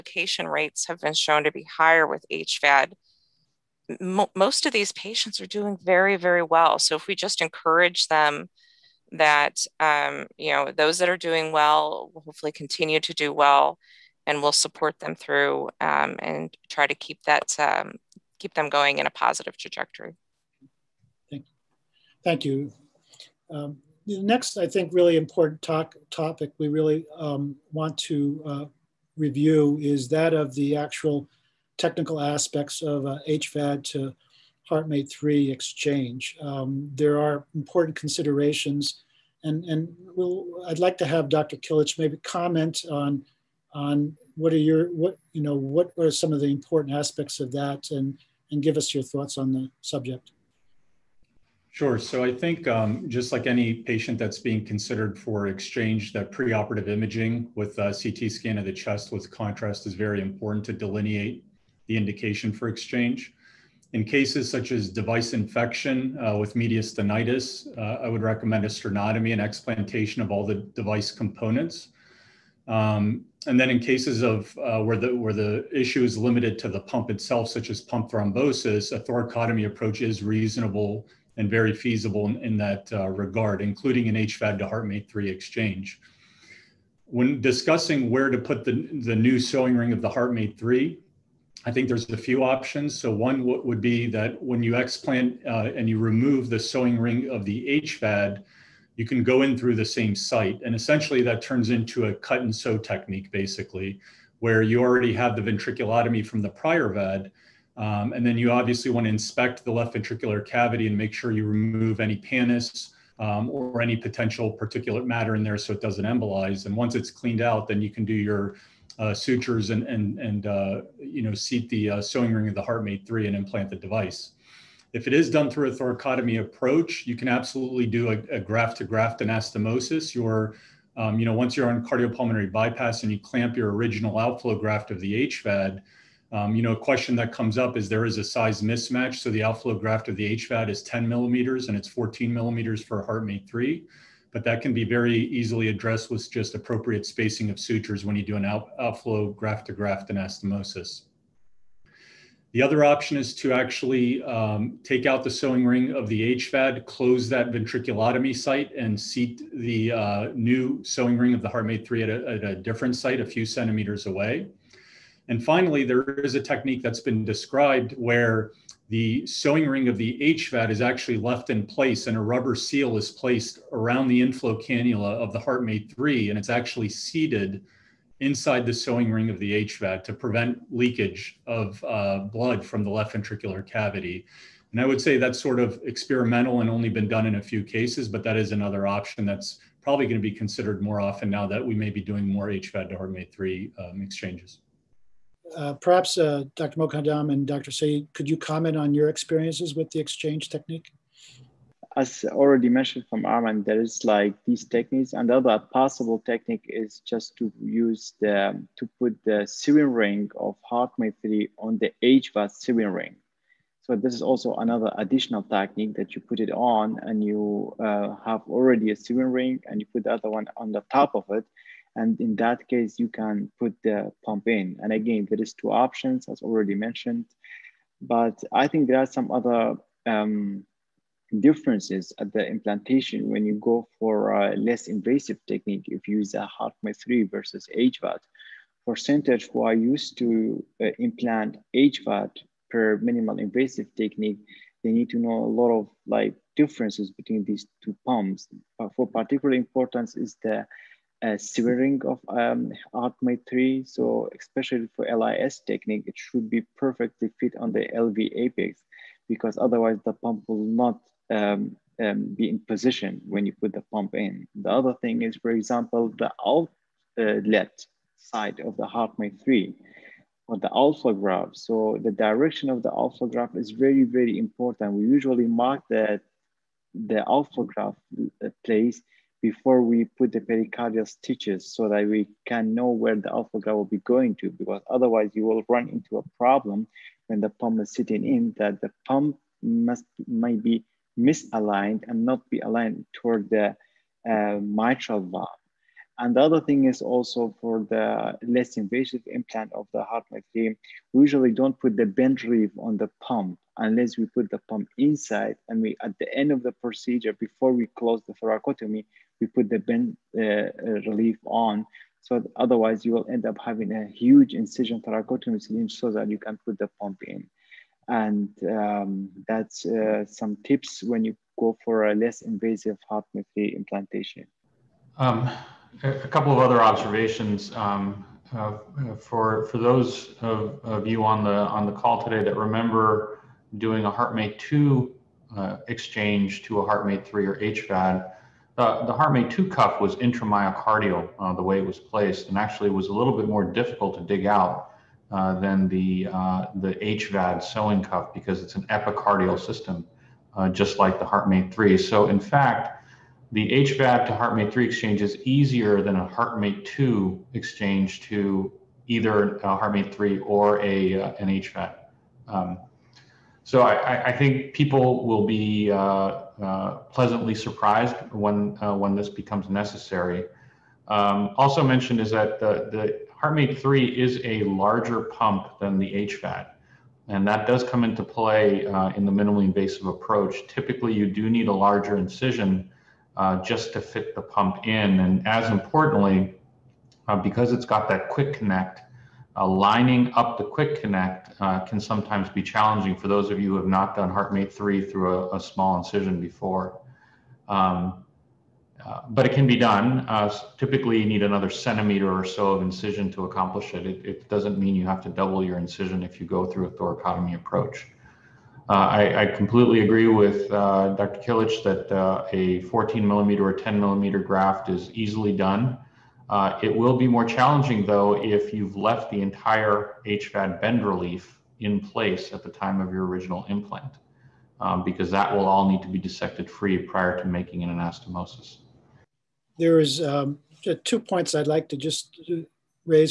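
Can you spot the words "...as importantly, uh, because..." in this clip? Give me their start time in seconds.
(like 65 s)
385 s.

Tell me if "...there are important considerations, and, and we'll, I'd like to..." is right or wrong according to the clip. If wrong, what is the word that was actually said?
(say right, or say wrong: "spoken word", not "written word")
right.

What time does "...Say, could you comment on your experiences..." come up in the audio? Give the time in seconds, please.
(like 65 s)
197 s.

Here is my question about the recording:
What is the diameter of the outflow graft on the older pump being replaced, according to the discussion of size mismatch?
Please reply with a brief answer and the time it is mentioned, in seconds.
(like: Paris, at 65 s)
10 millimeters, at 140 s.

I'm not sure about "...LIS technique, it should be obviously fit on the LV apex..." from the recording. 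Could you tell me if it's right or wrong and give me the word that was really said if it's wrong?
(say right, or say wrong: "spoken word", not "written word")
wrong: "perfectly", not "obviously".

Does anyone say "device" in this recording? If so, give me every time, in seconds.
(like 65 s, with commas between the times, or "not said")
64 s, 70 s, 123 s.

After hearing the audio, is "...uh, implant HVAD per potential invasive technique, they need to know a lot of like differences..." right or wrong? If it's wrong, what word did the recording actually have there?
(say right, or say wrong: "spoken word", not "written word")
wrong: "minimal", not "potential".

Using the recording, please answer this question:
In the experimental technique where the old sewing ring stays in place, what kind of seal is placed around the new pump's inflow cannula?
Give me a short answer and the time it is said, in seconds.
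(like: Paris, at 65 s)
rubber seal, at 172 s.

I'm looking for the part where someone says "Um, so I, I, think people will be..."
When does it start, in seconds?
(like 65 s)
362 s.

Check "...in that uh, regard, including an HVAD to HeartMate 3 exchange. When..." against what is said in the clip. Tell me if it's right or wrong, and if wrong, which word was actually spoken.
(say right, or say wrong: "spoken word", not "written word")
right.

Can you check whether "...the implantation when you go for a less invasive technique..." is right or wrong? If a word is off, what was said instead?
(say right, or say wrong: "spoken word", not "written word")
right.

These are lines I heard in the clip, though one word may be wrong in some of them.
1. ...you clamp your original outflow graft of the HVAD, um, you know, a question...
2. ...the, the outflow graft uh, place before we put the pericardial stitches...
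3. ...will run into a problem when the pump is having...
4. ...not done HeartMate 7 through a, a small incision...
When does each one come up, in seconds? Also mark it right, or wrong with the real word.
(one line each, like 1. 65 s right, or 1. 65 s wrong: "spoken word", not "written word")
1. 133 s right
2. 275 s right
3. 285 s wrong: "sitting", not "having"
4. 393 s wrong: "3", not "7".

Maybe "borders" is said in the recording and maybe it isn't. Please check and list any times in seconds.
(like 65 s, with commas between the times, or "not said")
not said.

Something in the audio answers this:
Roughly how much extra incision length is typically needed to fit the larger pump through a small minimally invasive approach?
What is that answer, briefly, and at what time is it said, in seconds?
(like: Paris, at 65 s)
1 centimeter, at 401 s.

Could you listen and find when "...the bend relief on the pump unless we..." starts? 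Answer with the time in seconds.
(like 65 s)
301 s.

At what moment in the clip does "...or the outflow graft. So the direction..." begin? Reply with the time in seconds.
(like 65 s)
270 s.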